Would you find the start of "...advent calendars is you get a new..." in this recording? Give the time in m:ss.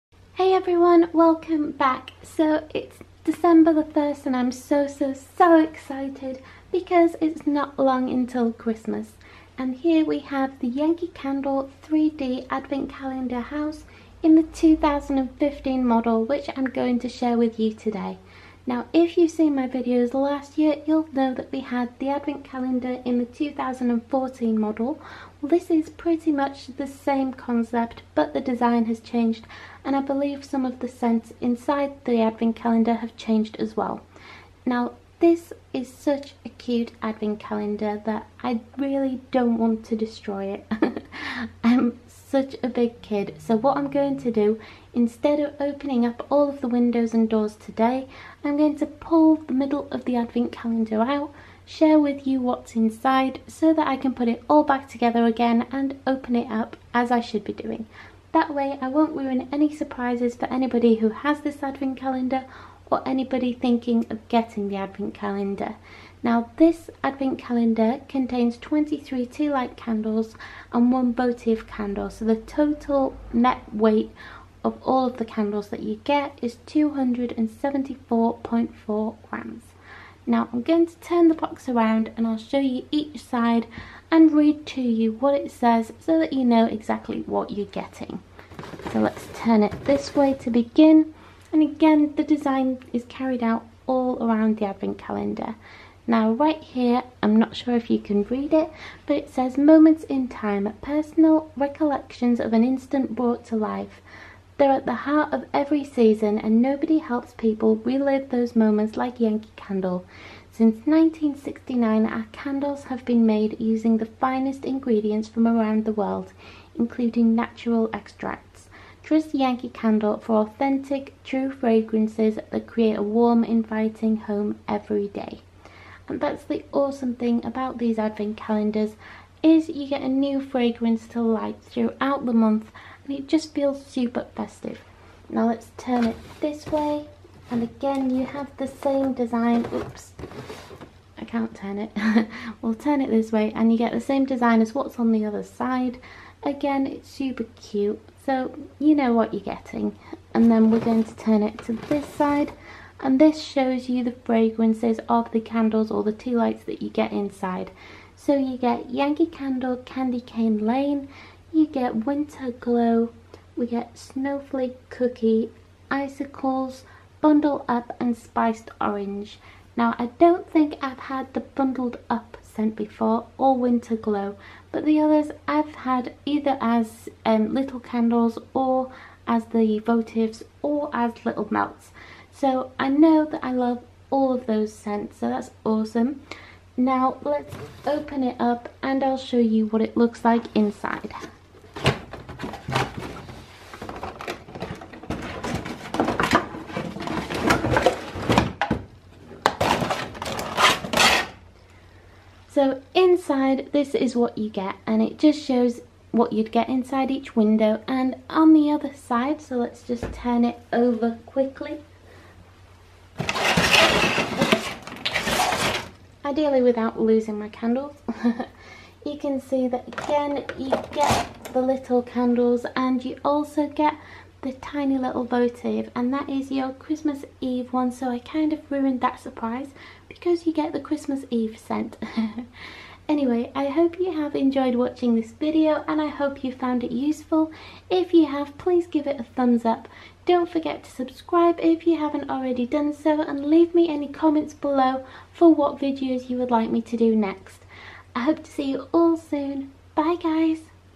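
2:07.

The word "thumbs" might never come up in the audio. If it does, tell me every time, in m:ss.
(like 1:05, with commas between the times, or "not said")
3:59.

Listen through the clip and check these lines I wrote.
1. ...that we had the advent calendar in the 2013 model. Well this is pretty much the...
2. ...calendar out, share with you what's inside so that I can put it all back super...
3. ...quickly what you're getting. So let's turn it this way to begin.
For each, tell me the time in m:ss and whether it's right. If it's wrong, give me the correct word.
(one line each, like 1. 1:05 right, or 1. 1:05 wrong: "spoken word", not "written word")
1. 0:21 wrong: "2014", not "2013"
2. 0:50 wrong: "together", not "super"
3. 1:26 wrong: "exactly", not "quickly".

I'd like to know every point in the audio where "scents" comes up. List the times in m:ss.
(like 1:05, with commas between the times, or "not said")
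0:30, 2:52, 3:04, 3:51.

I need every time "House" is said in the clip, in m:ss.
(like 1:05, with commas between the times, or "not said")
0:13.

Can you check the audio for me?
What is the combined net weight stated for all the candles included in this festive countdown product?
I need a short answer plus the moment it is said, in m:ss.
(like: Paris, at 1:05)
274.4 grams, at 1:16.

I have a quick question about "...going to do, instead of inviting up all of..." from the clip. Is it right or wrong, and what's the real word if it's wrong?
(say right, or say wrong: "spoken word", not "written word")
wrong: "opening", not "inviting".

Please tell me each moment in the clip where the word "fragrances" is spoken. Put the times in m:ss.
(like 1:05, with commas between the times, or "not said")
2:01, 2:10, 2:34.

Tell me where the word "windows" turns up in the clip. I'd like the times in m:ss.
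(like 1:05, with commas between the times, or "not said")
0:46, 3:27.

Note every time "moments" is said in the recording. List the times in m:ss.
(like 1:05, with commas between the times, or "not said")
1:39, 1:48.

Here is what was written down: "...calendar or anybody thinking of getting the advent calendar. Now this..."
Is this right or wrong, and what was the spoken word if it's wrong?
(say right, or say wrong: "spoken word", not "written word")
right.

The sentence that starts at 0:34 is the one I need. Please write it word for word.
Now this is such a cute advent calendar that I really don't want to destroy it.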